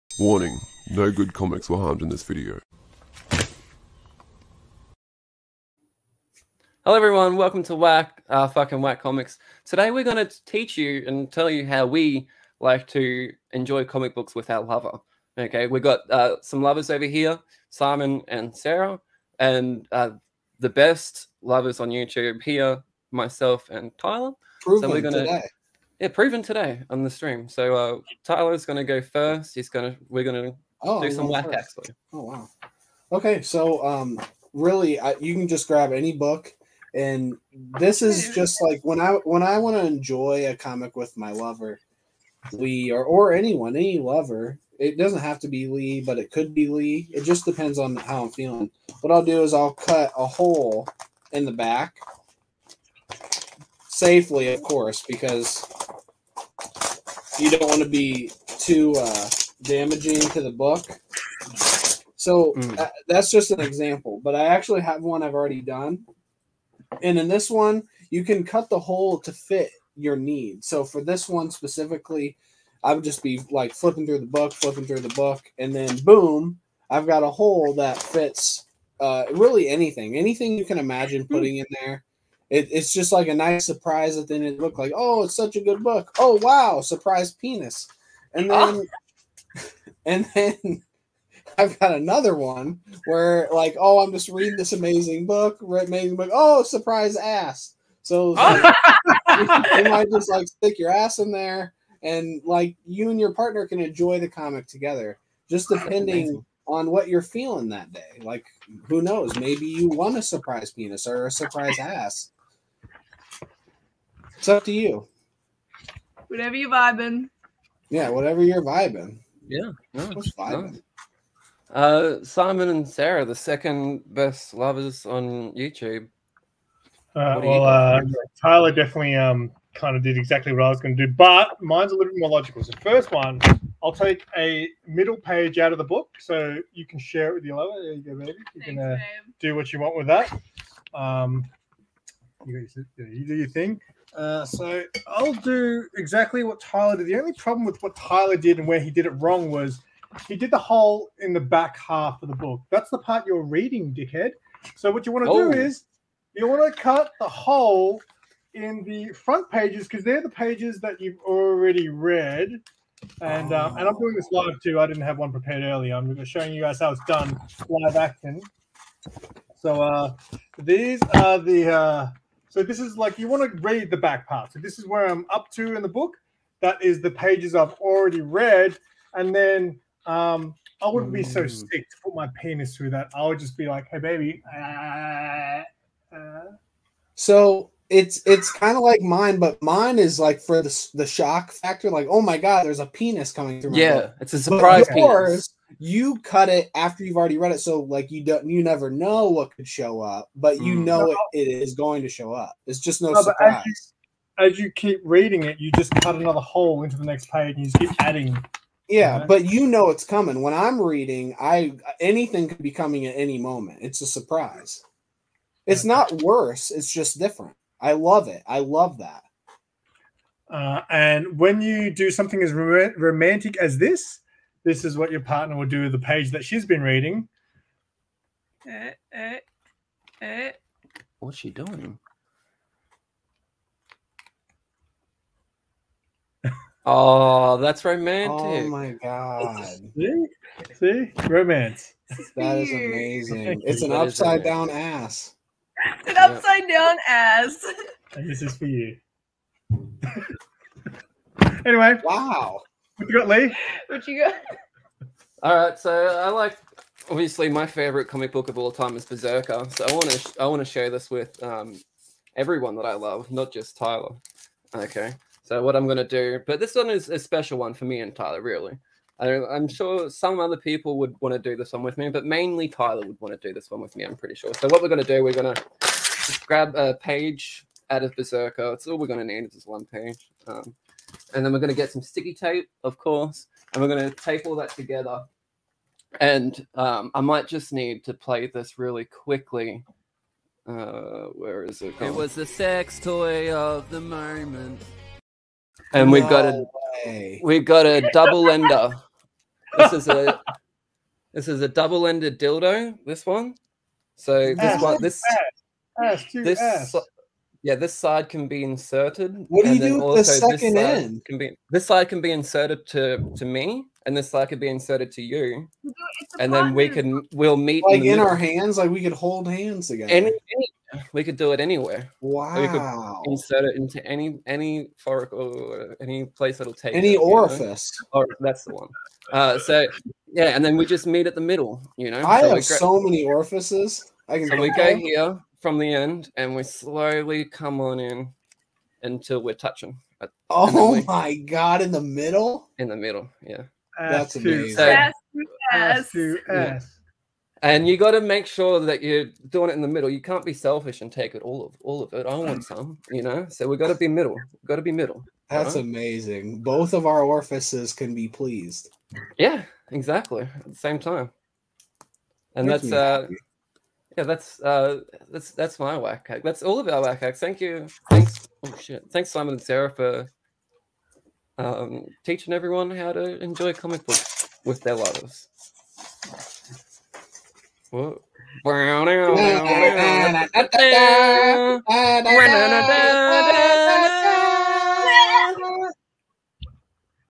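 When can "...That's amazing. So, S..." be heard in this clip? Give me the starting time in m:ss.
5:44.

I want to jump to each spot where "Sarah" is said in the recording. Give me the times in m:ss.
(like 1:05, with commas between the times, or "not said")
0:18, 2:02, 6:09.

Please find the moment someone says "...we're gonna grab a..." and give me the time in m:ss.
4:35.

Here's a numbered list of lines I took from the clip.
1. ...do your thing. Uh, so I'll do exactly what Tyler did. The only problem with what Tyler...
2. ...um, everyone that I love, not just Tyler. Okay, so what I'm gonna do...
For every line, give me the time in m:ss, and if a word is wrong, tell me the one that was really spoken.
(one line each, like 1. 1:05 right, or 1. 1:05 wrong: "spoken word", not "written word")
1. 2:22 right
2. 4:21 right.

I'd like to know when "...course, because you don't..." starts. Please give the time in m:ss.
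0:54.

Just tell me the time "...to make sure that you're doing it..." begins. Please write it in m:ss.
5:48.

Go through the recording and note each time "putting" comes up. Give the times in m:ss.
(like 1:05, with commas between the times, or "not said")
1:21.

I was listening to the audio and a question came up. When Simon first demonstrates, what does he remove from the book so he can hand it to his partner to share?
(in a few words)
a middle page.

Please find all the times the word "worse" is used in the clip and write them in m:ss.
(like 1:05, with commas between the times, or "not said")
3:36.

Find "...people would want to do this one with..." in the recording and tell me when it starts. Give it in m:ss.
4:30.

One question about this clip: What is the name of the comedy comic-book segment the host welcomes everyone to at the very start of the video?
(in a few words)
Whack Comics.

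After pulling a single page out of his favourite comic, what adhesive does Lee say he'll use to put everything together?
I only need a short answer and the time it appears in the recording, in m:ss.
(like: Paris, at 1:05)
sticky tape, at 4:42.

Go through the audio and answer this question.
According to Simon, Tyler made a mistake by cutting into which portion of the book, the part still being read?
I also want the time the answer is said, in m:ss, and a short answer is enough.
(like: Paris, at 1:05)
the back half, at 2:31.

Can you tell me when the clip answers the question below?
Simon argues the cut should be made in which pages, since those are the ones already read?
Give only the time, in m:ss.
2:39.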